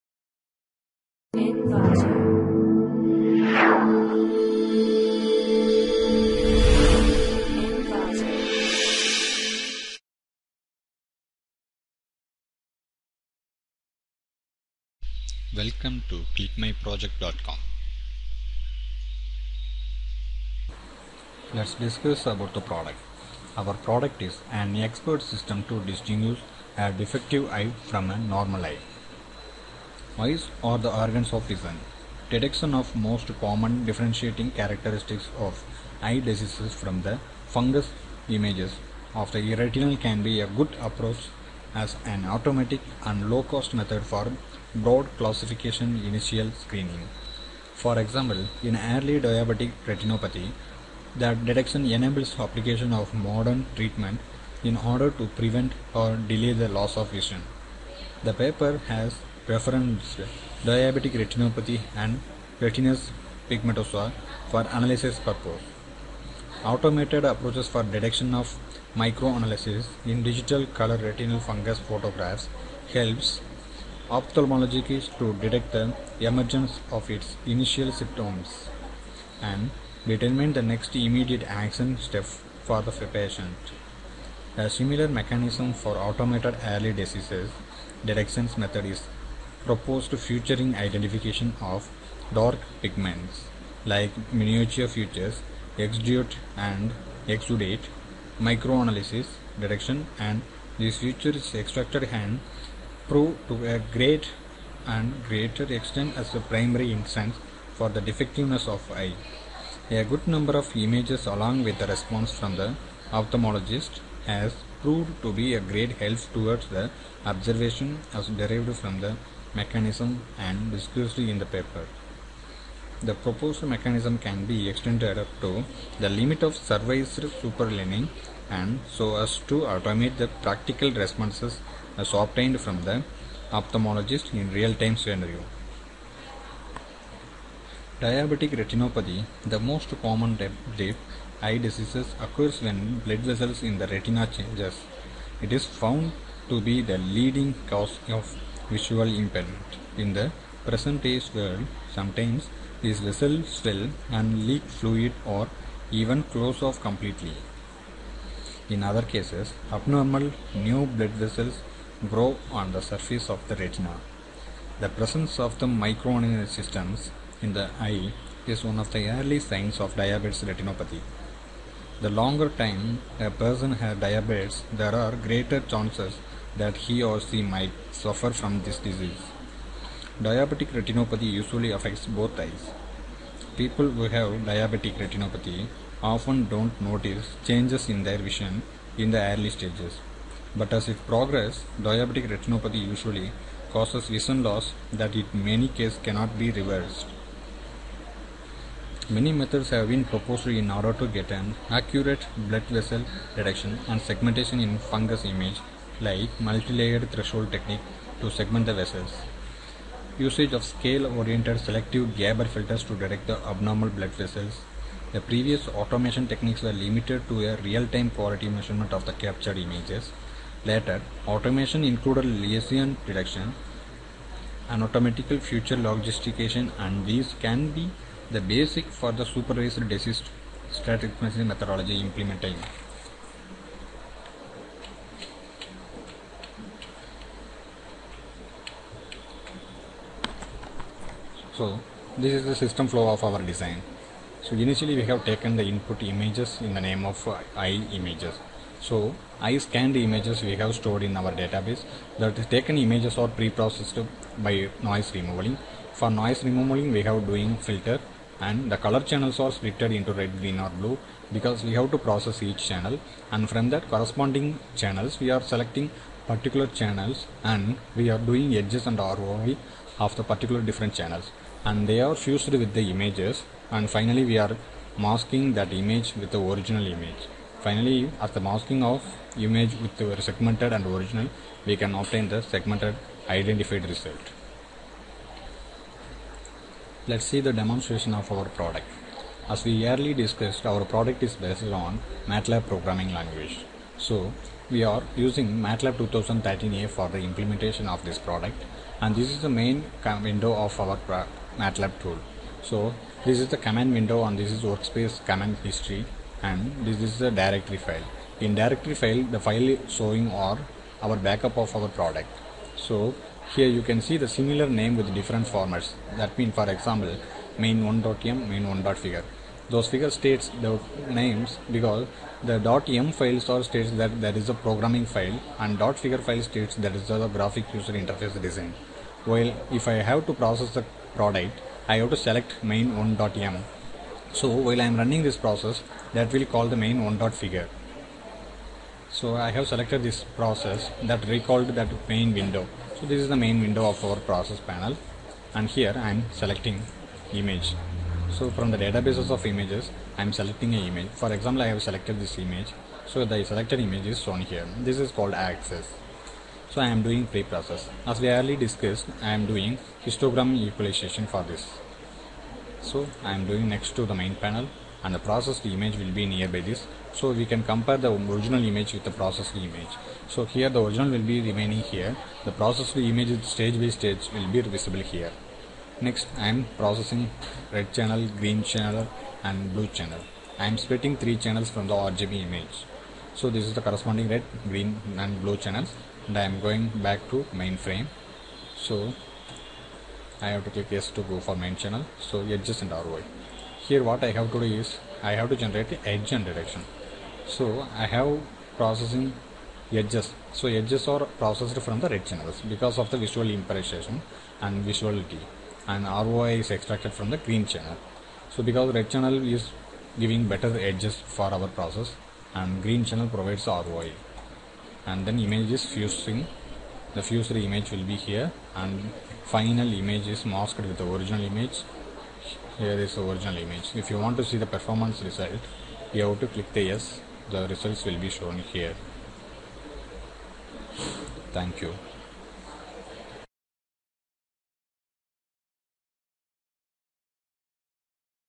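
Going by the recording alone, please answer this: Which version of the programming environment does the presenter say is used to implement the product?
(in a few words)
MATLAB 2013a.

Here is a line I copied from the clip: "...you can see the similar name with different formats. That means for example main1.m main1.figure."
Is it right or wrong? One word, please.
right.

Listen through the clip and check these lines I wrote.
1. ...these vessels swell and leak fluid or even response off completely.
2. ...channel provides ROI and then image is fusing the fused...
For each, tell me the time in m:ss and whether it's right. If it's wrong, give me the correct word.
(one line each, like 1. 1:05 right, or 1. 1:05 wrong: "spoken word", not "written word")
1. 2:32 wrong: "close", not "response"
2. 6:53 right.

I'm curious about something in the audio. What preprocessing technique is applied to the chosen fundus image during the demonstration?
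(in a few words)
Histogram equalization.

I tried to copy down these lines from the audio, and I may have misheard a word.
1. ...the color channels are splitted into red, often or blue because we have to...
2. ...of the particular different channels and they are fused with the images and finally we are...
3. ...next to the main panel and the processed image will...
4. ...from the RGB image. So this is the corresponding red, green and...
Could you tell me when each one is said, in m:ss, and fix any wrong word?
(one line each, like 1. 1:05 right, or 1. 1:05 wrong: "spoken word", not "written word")
1. 4:18 wrong: "green", not "often"
2. 4:29 right
3. 6:03 right
4. 6:21 right.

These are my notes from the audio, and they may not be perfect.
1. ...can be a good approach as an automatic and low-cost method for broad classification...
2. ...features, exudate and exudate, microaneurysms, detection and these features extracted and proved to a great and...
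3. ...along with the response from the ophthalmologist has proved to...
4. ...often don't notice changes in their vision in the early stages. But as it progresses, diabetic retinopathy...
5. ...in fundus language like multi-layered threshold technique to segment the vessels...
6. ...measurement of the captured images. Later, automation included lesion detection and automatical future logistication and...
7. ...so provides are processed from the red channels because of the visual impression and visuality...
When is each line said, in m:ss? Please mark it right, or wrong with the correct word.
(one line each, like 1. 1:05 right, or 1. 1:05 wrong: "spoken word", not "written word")
1. 0:39 right
2. 1:34 right
3. 1:51 right
4. 3:06 right
5. 3:24 wrong: "image", not "language"
6. 3:38 right
7. 6:40 wrong: "edges", not "provides".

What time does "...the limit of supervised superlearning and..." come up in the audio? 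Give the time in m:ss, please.
2:05.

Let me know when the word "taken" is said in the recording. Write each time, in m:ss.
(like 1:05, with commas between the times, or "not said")
4:05, 4:12.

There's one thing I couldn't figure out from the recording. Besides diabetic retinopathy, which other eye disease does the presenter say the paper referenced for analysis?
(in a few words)
Retinitis pigmentosa.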